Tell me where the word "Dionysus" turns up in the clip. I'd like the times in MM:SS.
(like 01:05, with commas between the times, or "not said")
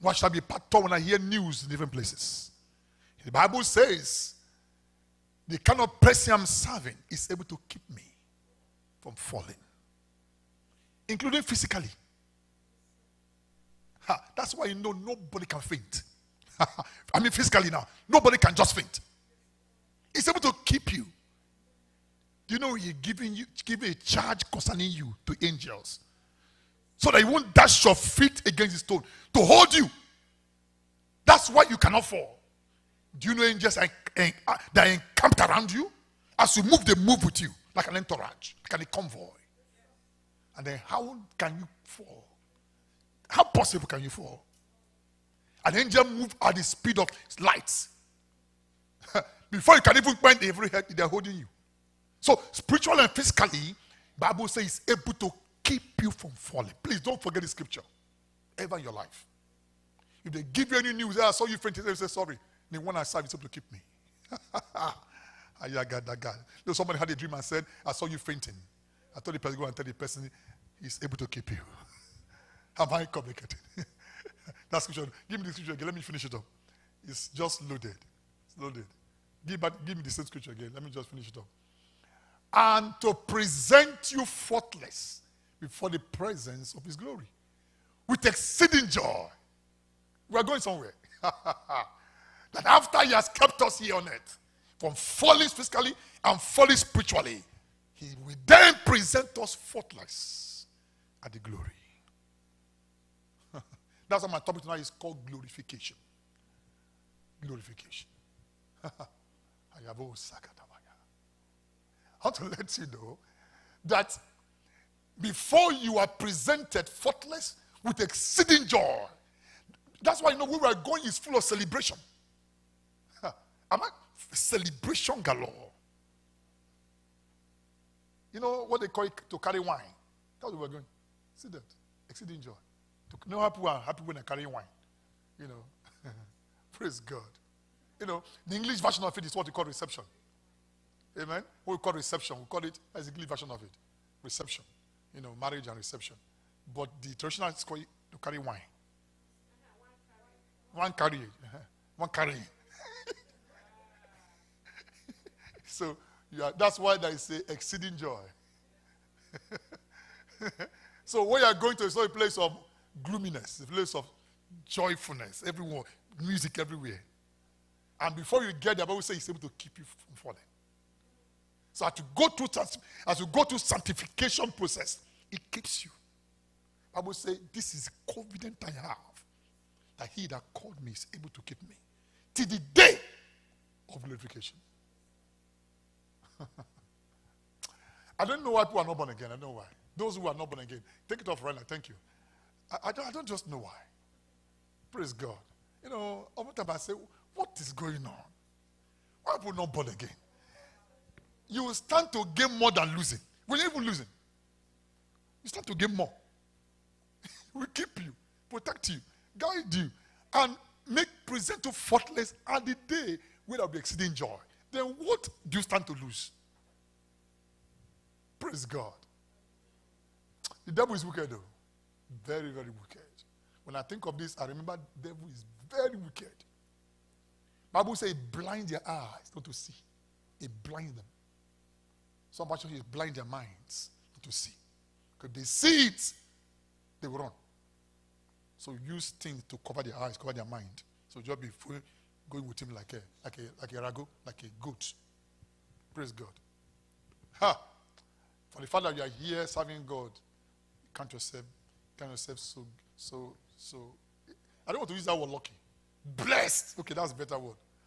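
not said.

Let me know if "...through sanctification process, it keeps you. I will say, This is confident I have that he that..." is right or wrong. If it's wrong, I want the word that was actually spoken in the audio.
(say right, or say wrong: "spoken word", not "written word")
right.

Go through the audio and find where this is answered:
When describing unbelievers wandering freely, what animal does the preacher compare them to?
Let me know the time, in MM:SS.
04:04.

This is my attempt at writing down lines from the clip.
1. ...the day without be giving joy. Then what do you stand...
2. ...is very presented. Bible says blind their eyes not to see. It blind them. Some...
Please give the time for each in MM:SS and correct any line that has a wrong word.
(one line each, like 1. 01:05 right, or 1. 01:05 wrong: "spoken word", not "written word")
1. 03:32 wrong: "exceeding", not "giving"
2. 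03:45 wrong: "wicked", not "presented".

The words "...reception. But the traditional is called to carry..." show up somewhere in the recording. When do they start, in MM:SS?
02:25.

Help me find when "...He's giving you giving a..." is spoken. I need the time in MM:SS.
00:22.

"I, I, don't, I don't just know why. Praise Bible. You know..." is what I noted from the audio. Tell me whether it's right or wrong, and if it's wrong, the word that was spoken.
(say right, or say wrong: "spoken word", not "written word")
wrong: "God", not "Bible".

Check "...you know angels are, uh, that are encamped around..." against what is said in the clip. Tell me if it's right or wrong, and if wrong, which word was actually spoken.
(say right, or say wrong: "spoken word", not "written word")
right.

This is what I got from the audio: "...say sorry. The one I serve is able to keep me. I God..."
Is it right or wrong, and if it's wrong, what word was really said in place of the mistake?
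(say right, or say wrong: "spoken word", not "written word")
right.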